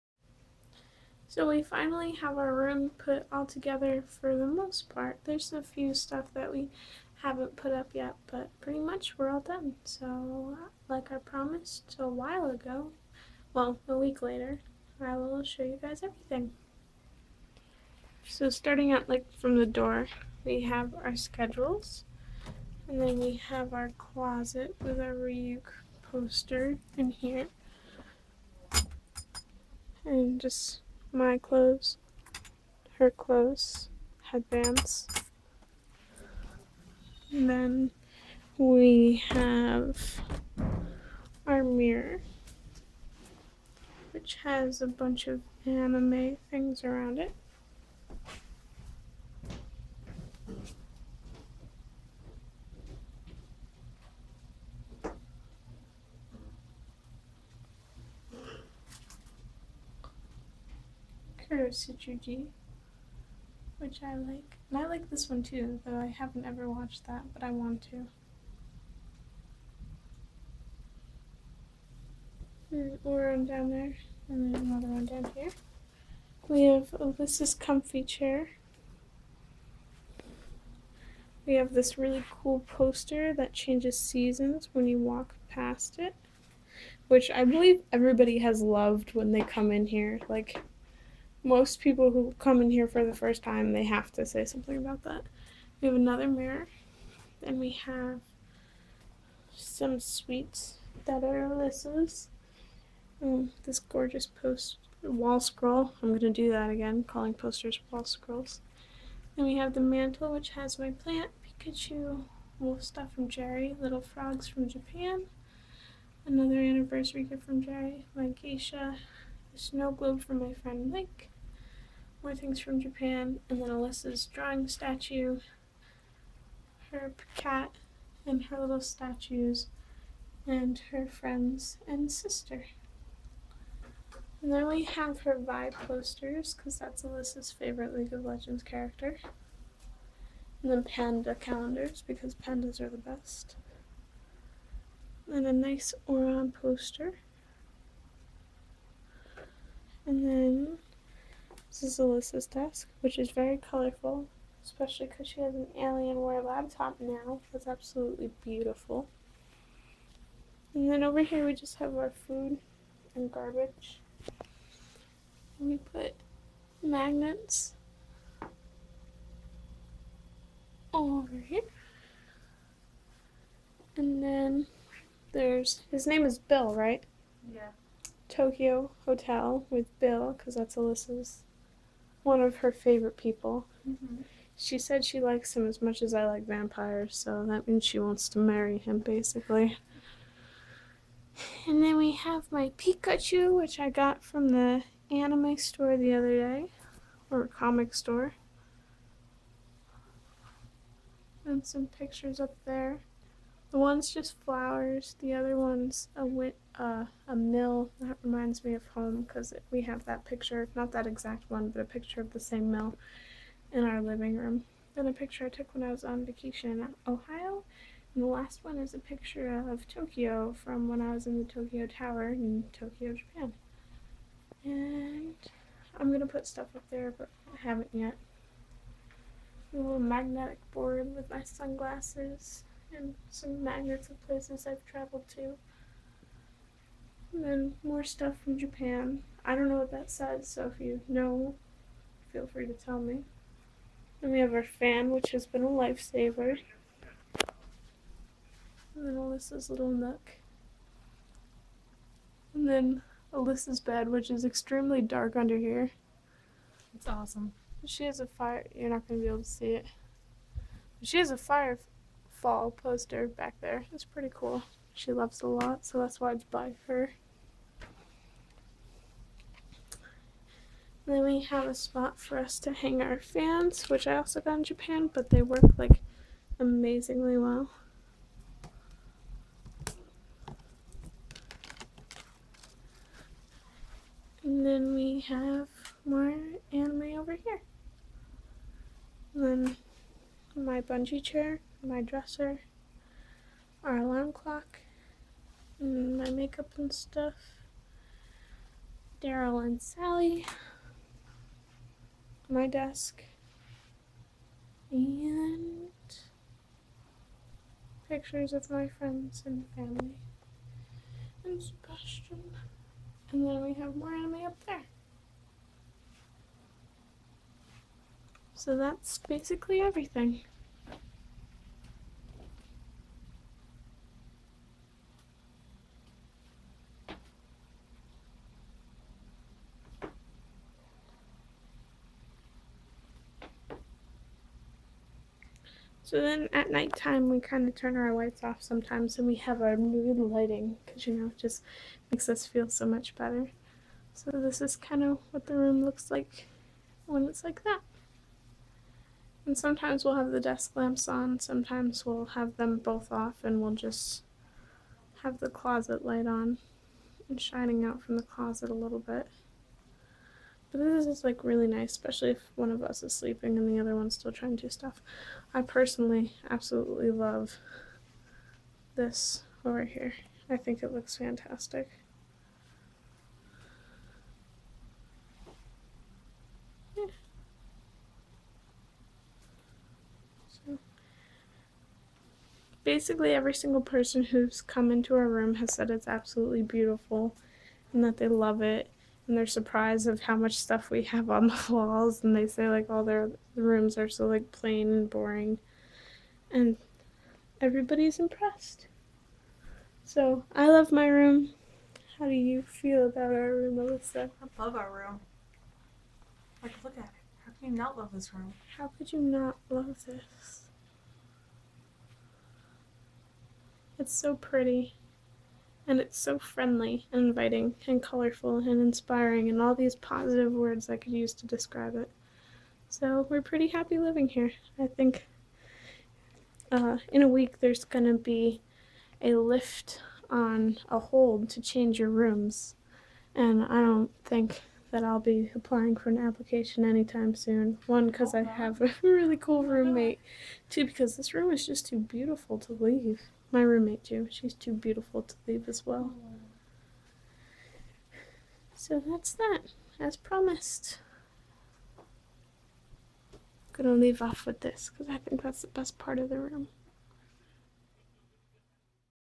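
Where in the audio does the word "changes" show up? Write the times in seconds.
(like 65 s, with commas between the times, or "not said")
83 s, 431 s.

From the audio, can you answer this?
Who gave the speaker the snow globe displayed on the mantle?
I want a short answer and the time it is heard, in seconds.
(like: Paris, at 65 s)
Mike, at 120 s.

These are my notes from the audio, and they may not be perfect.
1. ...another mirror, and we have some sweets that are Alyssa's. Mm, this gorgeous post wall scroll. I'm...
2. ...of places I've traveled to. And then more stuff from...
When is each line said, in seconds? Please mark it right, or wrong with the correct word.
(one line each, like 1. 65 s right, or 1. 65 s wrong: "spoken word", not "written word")
1. 95 s right
2. 234 s right.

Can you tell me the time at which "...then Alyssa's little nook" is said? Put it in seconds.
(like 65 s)
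249 s.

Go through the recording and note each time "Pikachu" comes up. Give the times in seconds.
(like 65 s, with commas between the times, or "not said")
111 s, 192 s.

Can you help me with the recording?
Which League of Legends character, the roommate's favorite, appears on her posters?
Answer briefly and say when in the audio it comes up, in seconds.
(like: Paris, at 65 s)
Vi, at 135 s.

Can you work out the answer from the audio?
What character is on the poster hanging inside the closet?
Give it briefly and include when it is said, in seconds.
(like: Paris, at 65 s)
Ryuk, at 25 s.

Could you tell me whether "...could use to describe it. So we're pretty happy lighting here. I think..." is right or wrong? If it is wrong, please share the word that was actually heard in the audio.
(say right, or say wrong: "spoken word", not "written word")
wrong: "living", not "lighting".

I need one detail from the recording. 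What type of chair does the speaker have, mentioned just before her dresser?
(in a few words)
bungee chair.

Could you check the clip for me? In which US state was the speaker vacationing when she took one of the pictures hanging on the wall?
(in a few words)
Ohio.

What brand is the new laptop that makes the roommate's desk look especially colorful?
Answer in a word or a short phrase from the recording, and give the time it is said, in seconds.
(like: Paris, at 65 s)
Alienware, at 155 s.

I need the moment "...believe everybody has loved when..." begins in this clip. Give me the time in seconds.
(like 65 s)
87 s.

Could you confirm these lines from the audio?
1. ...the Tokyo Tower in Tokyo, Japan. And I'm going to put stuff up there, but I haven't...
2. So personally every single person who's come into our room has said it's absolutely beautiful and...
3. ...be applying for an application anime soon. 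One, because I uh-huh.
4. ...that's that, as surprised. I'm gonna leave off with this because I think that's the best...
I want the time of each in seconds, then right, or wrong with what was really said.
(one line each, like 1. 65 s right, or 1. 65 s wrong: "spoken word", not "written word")
1. 221 s right
2. 380 s wrong: "basically", not "personally"
3. 435 s wrong: "anytime", not "anime"
4. 449 s wrong: "promised", not "surprised".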